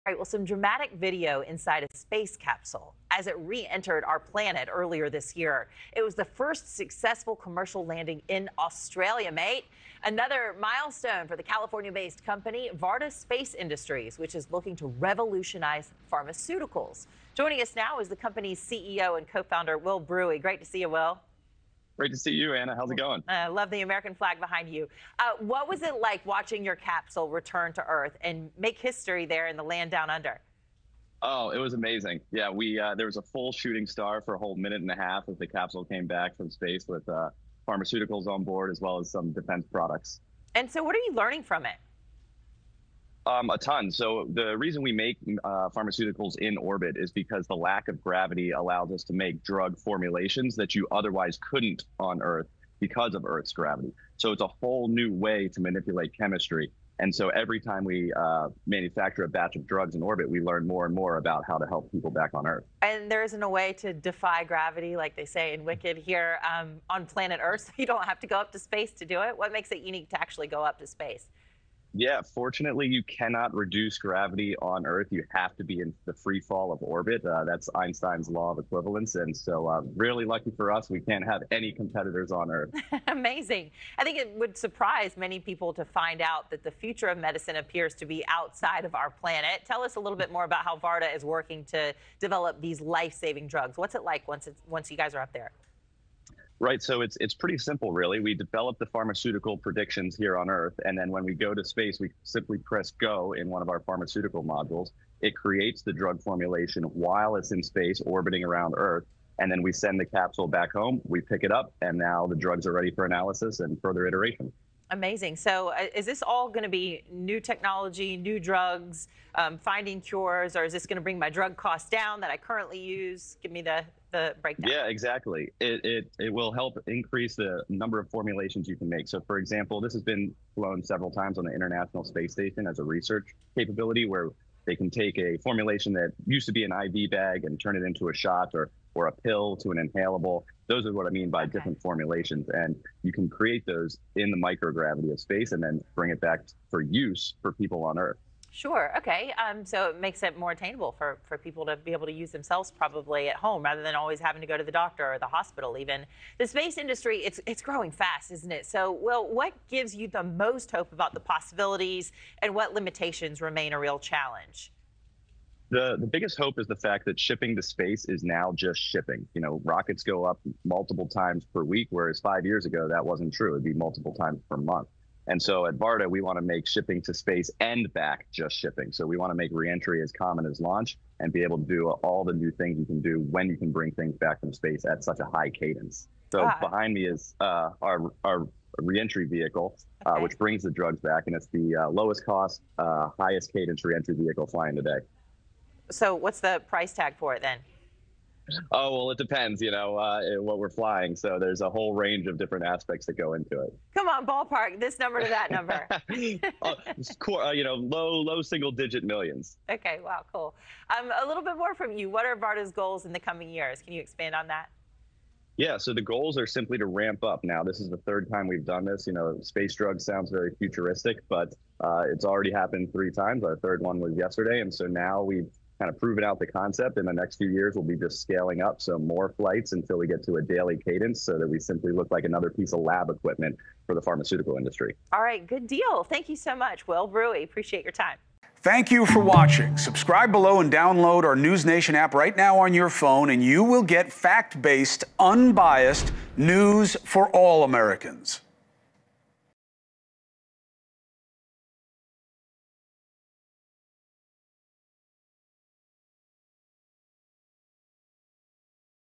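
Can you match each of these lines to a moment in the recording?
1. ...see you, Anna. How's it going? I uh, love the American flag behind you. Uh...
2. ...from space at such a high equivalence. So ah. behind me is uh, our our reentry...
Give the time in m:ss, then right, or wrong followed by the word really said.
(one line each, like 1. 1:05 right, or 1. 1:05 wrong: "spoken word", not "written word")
1. 0:22 right
2. 3:04 wrong: "cadence", not "equivalence".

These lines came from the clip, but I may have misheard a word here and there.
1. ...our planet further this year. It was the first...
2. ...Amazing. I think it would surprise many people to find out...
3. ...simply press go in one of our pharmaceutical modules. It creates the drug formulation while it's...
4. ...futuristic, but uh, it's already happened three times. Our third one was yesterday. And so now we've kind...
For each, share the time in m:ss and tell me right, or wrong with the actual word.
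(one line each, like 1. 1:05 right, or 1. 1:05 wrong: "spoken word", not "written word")
1. 0:04 wrong: "earlier", not "further"
2. 1:23 right
3. 1:42 right
4. 3:40 right.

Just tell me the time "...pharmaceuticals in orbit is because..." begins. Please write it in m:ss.
0:45.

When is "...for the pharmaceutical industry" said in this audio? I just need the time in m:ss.
3:53.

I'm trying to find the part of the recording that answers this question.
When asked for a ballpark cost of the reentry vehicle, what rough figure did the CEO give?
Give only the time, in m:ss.
3:27.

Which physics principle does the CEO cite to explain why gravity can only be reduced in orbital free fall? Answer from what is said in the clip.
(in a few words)
Einstein's law of equivalence.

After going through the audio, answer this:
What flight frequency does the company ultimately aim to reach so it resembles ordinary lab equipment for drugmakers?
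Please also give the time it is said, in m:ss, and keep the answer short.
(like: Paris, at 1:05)
daily cadence, at 3:50.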